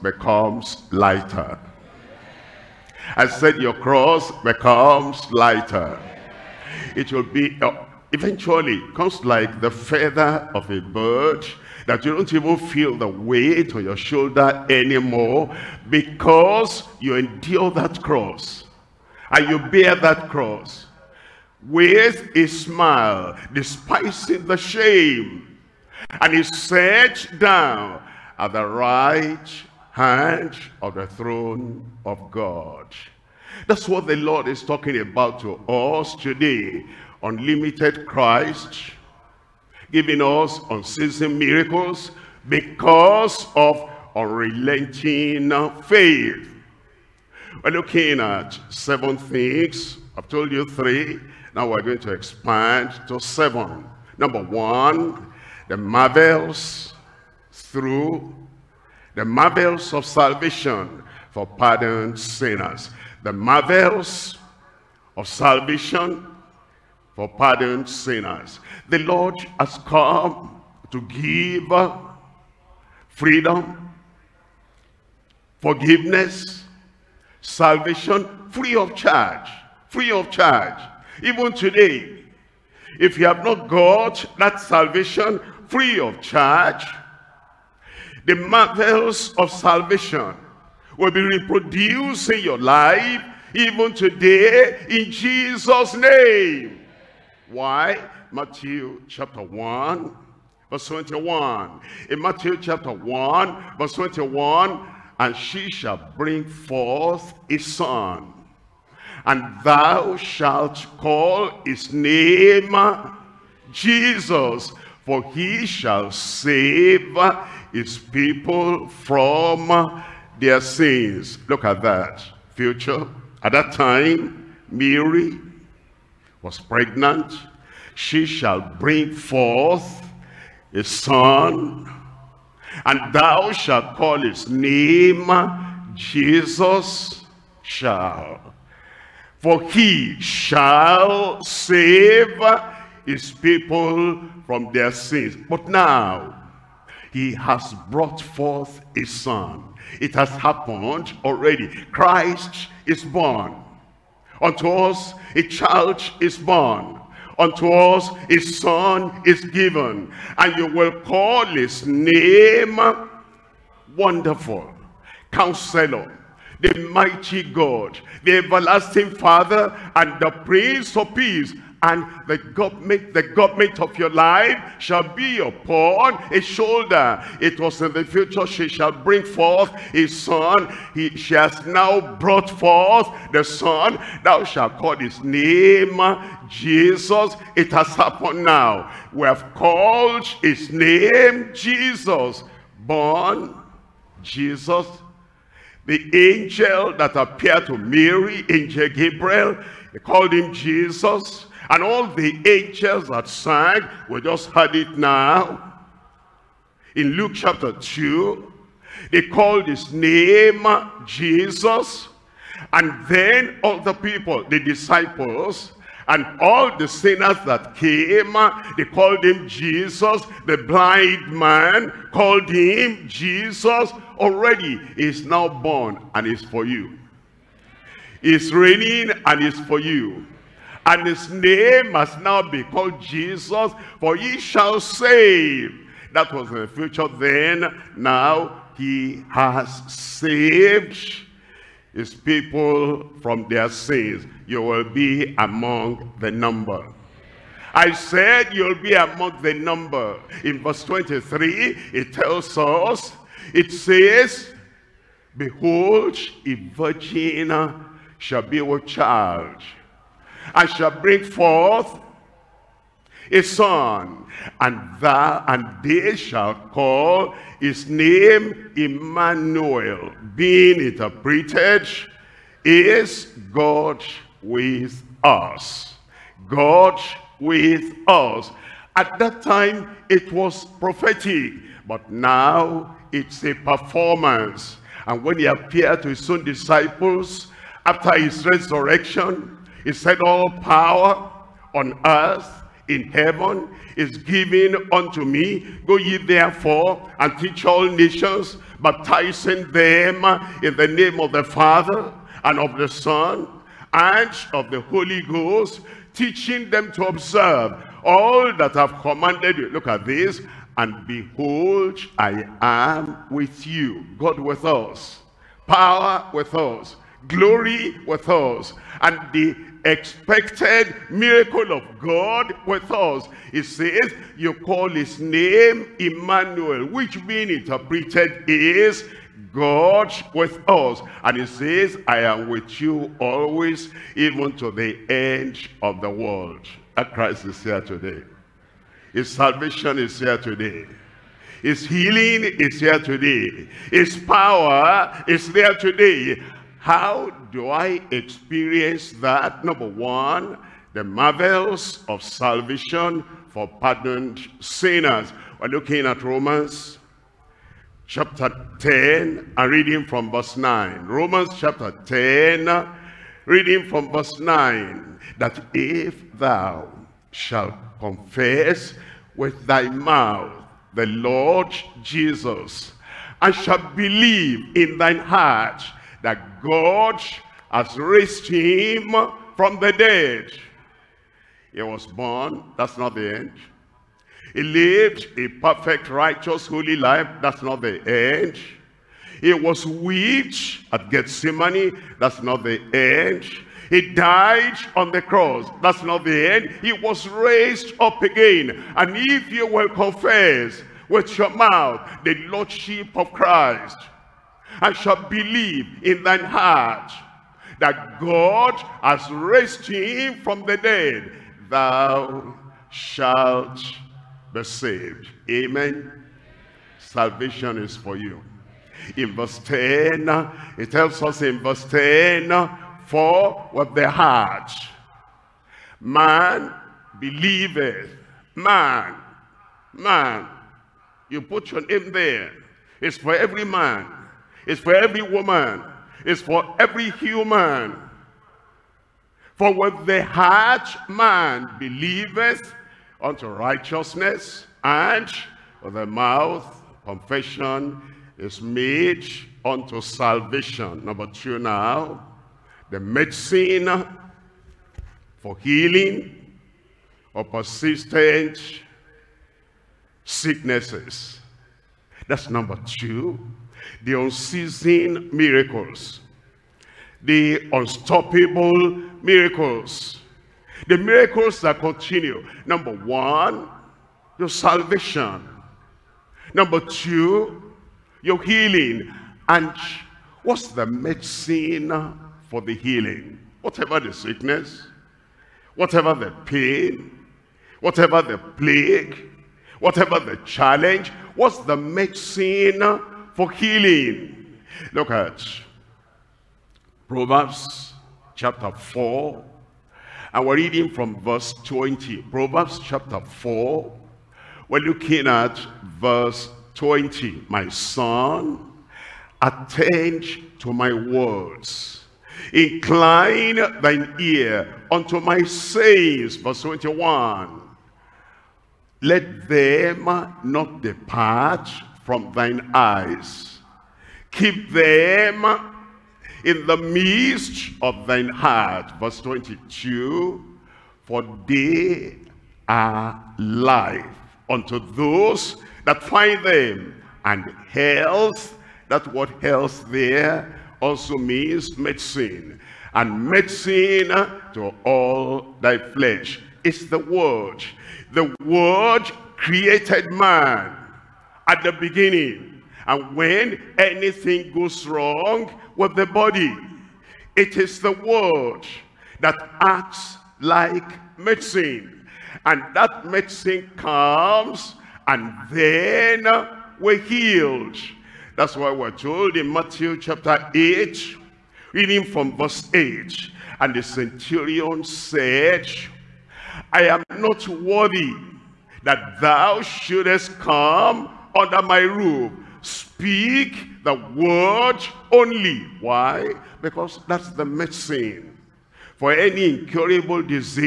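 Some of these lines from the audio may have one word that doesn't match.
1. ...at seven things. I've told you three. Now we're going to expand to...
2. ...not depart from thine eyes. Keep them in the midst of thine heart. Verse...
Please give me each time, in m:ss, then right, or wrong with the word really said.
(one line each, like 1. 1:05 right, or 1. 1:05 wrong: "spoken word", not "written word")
1. 0:48 right
2. 8:40 right.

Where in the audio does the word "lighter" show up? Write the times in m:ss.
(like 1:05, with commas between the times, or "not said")
0:00, 0:05.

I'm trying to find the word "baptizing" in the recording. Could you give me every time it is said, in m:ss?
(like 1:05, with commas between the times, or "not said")
4:58.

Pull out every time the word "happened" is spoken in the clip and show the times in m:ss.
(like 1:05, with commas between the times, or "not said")
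2:30, 3:07.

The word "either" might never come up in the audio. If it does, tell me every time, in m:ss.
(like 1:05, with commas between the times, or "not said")
not said.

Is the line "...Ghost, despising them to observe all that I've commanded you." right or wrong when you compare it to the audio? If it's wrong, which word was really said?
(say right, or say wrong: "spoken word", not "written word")
wrong: "teaching", not "despising".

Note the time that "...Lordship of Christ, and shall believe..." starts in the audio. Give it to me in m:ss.
6:42.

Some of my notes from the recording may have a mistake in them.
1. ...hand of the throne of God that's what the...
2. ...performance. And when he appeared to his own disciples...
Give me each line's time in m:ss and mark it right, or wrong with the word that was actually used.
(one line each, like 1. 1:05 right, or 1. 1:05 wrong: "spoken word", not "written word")
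1. 0:29 right
2. 4:43 right.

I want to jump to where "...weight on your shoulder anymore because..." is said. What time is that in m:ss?
0:13.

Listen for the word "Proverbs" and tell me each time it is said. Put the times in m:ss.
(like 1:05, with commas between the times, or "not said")
8:17, 8:22.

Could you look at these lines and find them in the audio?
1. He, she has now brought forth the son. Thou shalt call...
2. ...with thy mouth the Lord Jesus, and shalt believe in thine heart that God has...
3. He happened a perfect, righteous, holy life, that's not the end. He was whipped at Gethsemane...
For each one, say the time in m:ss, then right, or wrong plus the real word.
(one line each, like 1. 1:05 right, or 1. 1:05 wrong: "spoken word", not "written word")
1. 3:00 right
2. 6:09 right
3. 6:24 wrong: "lived", not "happened".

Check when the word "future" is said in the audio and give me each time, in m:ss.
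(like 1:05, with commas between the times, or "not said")
2:02, 2:58, 3:56.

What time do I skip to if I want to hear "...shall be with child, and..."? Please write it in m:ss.
4:18.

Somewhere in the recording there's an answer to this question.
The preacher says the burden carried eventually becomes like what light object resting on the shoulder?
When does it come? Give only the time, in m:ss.
0:09.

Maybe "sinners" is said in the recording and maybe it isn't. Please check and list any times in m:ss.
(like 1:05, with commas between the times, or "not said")
1:02, 1:07, 3:36, 5:54.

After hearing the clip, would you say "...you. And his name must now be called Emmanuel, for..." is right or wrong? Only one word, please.
wrong.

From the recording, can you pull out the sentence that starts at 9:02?
And medicine to all thy flesh.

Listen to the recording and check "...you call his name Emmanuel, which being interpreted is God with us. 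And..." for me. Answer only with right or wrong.
right.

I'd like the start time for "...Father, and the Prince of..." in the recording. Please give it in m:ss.
2:49.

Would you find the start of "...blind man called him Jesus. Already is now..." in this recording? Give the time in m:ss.
3:40.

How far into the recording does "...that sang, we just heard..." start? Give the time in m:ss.
3:23.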